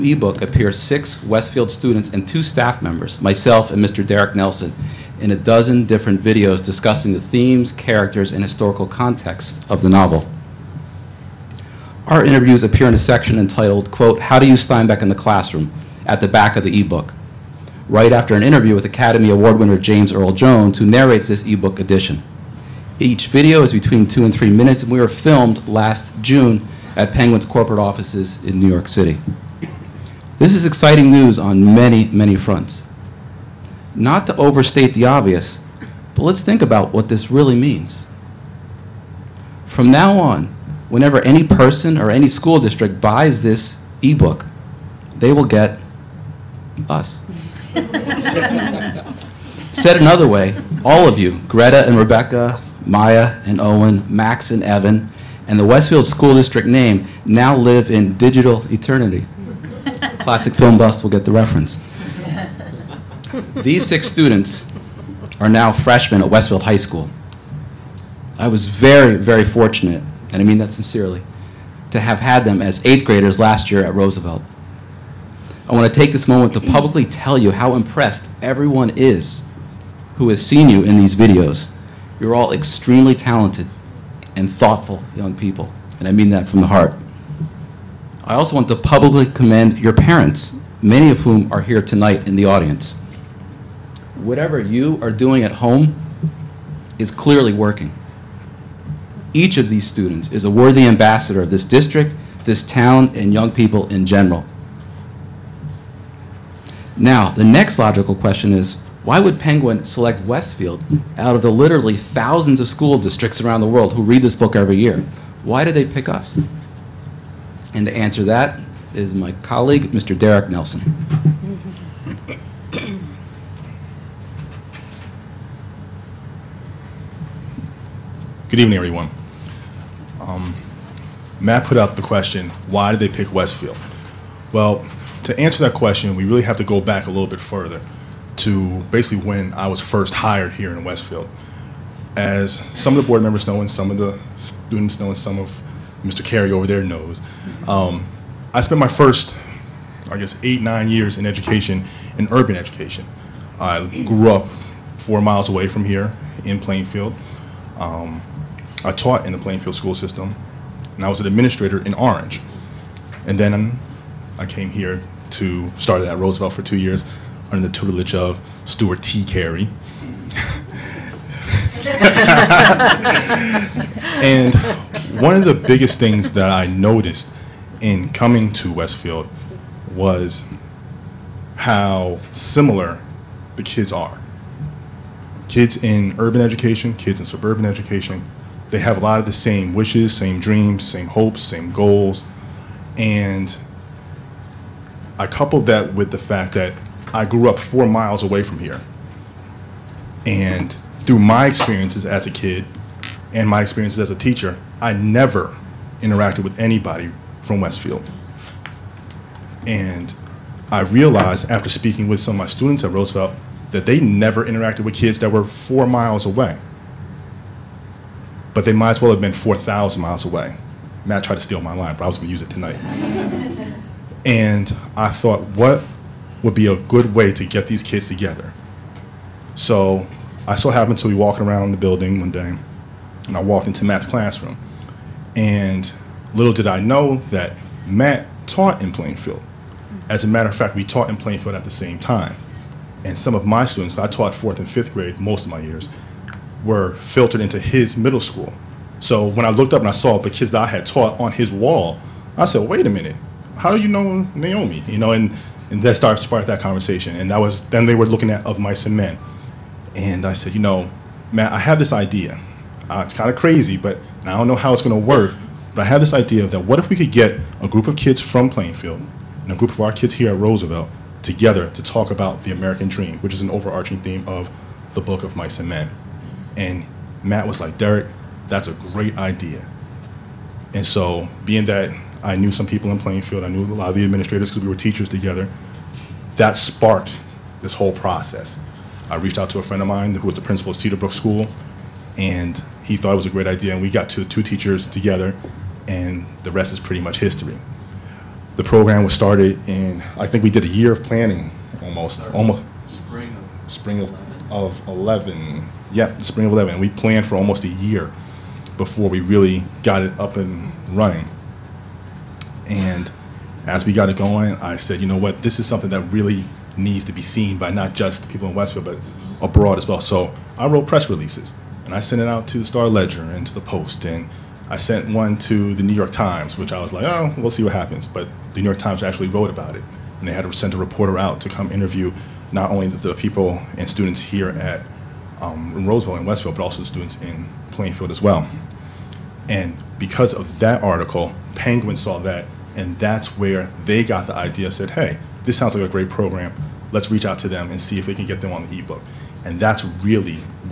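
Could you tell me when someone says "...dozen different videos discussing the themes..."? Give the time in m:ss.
0:05.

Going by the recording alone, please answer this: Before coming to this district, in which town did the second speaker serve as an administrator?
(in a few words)
Orange.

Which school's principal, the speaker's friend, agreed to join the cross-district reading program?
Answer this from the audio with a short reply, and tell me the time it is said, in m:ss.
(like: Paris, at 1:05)
Cedarbrook School, at 4:50.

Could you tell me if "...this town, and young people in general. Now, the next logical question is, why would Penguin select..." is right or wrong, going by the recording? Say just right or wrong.
right.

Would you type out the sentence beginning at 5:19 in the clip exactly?
So I wrote press releases and I sent it out to the Star Ledger and to the Post.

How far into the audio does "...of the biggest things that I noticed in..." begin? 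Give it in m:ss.
2:55.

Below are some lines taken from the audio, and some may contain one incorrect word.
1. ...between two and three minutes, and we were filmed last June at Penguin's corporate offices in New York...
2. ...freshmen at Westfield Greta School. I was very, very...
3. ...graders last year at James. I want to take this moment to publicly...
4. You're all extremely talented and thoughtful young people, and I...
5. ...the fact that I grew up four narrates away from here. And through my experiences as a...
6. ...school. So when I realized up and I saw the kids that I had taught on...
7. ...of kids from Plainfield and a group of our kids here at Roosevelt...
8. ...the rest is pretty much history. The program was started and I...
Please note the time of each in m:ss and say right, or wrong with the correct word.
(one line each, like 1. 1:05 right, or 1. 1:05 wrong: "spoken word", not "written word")
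1. 0:23 right
2. 1:05 wrong: "High", not "Greta"
3. 1:13 wrong: "Roosevelt", not "James"
4. 1:22 right
5. 3:16 wrong: "miles", not "narrates"
6. 4:08 wrong: "looked", not "realized"
7. 4:27 right
8. 4:56 right.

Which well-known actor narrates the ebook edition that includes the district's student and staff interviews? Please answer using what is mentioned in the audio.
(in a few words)
James Earl Jones.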